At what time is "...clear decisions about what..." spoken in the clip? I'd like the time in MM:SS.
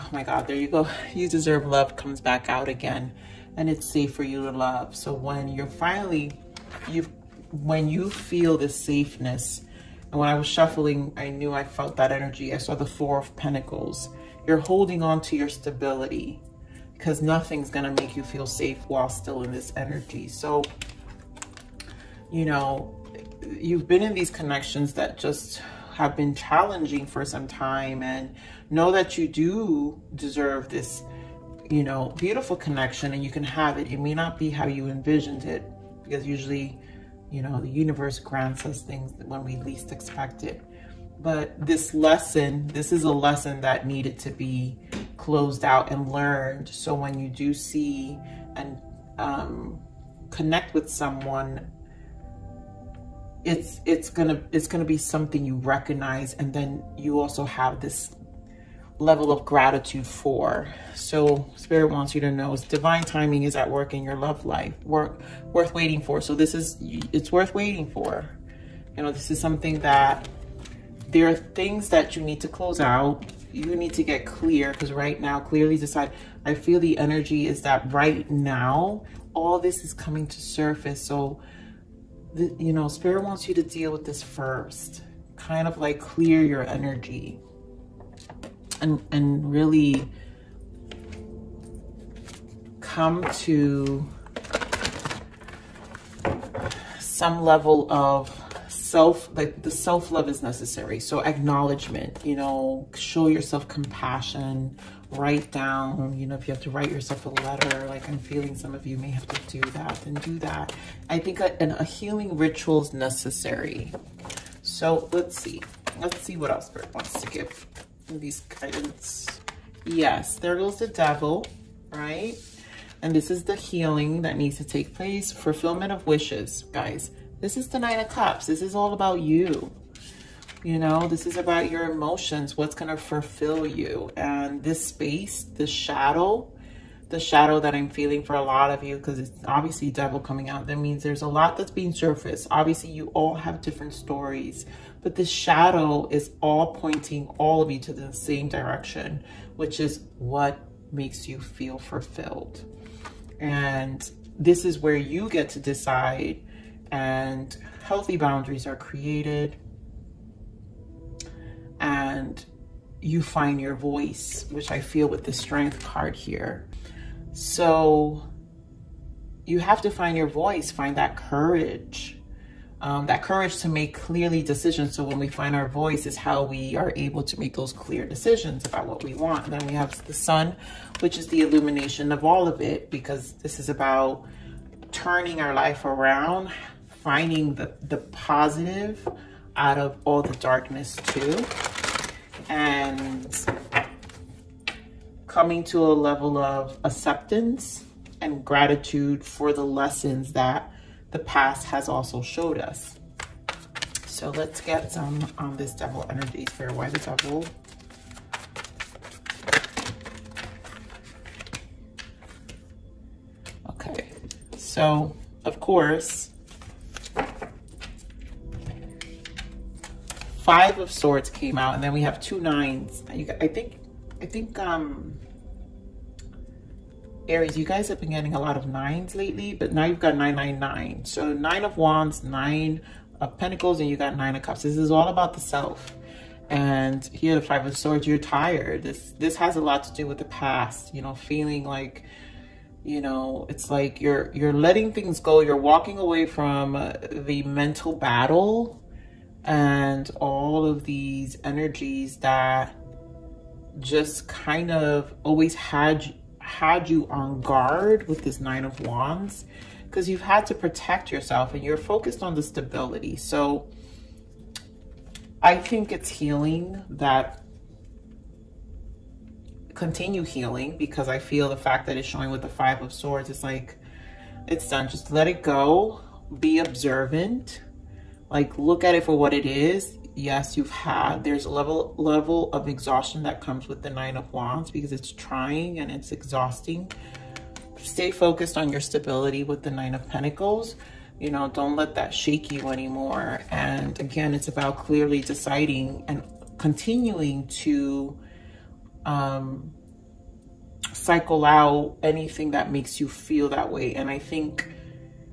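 02:57.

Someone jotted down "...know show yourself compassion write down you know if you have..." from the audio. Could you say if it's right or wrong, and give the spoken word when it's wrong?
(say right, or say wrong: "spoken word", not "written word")
right.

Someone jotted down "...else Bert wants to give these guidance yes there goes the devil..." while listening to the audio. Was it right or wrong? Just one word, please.
right.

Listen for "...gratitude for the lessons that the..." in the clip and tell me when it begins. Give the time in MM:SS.
03:18.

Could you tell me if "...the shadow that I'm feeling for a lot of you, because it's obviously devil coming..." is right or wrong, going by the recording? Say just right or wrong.
right.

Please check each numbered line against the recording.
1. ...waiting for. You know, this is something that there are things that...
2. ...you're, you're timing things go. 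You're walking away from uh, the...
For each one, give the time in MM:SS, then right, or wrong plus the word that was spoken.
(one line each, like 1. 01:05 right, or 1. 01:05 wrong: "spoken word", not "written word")
1. 01:07 right
2. 04:03 wrong: "letting", not "timing".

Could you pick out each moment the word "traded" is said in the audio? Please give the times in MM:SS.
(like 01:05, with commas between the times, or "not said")
not said.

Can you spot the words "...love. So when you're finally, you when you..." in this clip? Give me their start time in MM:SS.
00:04.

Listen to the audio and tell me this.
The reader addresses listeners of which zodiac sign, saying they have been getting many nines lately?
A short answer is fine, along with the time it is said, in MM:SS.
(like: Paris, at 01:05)
Aries, at 03:47.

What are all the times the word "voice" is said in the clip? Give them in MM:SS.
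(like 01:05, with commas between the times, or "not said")
02:43, 02:50, 02:55.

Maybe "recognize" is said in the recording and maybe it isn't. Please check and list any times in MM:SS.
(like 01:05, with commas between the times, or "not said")
00:55.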